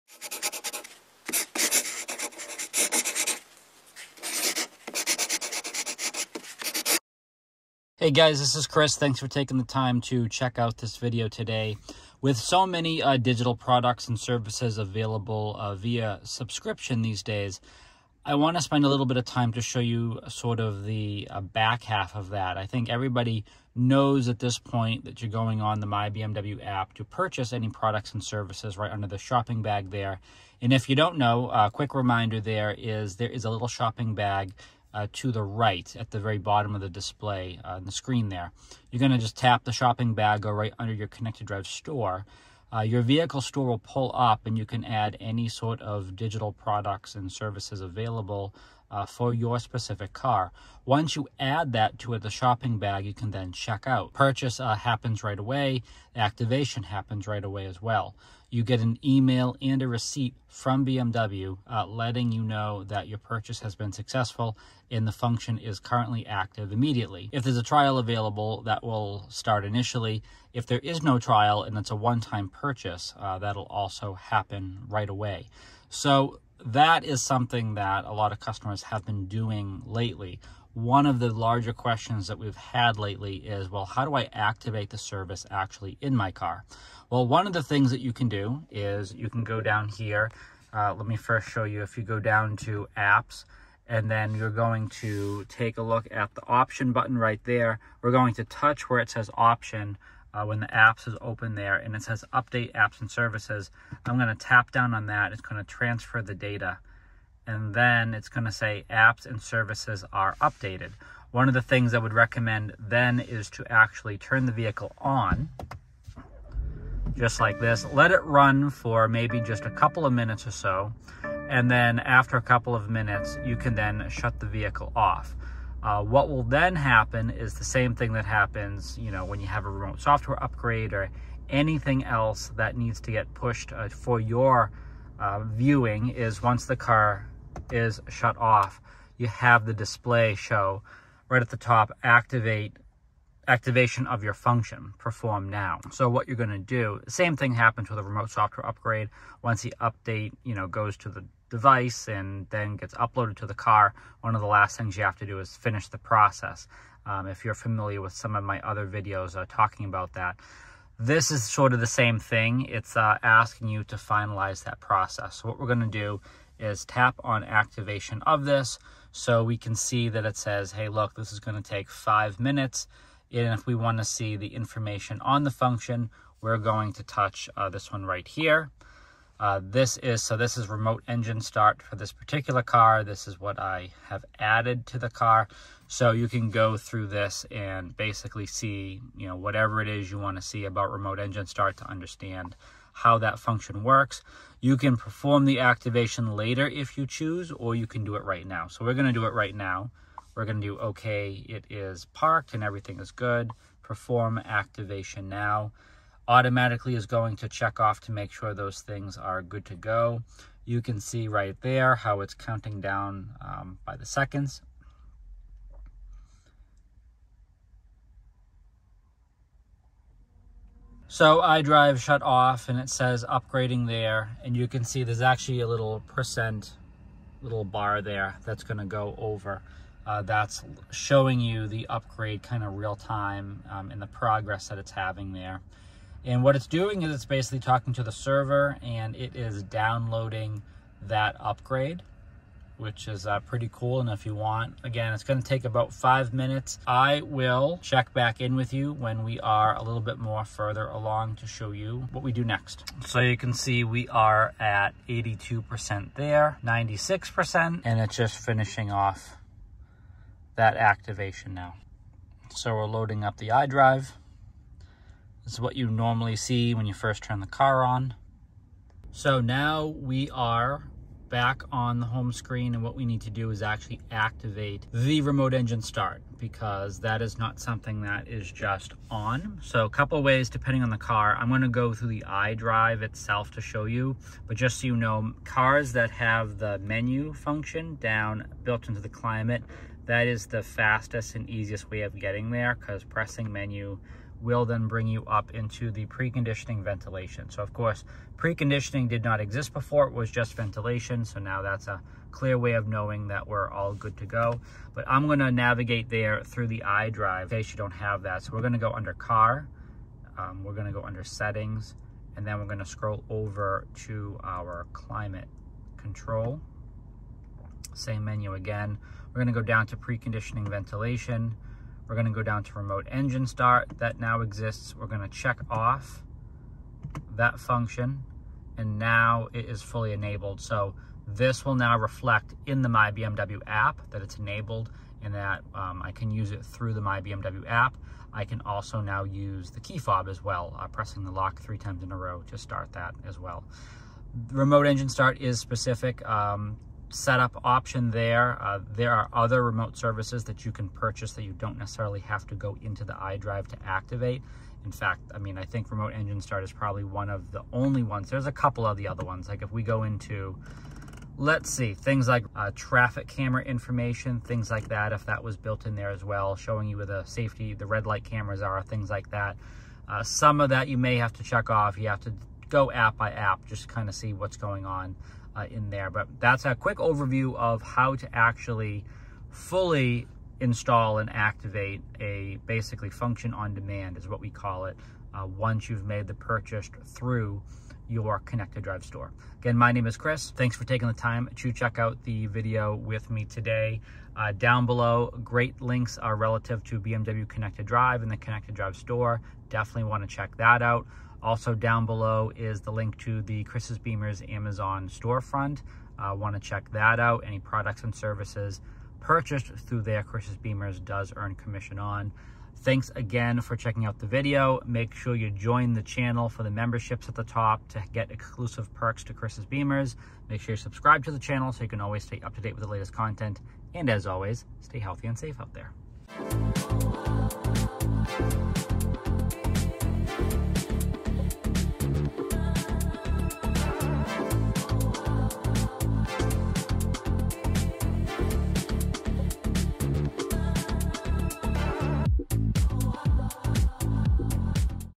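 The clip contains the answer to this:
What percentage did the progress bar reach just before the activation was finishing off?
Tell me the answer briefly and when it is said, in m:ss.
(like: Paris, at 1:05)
96%, at 4:16.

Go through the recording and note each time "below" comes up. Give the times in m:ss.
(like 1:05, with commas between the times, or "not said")
6:34, 6:42.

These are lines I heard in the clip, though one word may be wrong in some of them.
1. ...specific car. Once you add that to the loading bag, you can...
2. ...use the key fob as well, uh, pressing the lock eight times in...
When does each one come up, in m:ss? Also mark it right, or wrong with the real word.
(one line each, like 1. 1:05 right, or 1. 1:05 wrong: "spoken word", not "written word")
1. 0:49 wrong: "shopping", not "loading"
2. 5:39 wrong: "three", not "eight".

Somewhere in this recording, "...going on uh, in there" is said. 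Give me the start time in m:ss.
6:14.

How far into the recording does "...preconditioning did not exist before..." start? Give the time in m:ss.
4:58.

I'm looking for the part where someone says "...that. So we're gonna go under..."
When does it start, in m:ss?
5:08.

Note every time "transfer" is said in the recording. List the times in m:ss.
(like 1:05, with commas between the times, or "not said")
1:45.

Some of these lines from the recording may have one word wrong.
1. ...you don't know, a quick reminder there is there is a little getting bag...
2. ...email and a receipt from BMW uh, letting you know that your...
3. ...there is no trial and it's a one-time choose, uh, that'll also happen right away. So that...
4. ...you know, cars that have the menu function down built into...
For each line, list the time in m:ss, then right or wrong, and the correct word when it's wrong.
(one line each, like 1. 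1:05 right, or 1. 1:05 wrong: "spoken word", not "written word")
1. 0:30 wrong: "shopping", not "getting"
2. 0:59 right
3. 1:10 wrong: "purchase", not "choose"
4. 4:44 right.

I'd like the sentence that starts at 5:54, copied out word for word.
In fact, I mean, I think Remote Engine Start is probably one of the only ones.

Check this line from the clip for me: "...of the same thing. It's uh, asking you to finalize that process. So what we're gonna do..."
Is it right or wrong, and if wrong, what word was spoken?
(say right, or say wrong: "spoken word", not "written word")
right.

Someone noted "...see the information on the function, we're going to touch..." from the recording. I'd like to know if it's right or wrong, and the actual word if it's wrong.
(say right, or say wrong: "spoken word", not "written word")
right.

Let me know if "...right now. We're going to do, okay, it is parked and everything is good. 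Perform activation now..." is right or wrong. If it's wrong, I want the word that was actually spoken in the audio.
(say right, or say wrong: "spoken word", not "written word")
right.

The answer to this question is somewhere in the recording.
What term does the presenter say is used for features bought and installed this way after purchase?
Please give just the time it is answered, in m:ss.
6:23.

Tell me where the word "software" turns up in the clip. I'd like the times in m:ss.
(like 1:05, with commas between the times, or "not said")
2:09, 2:28.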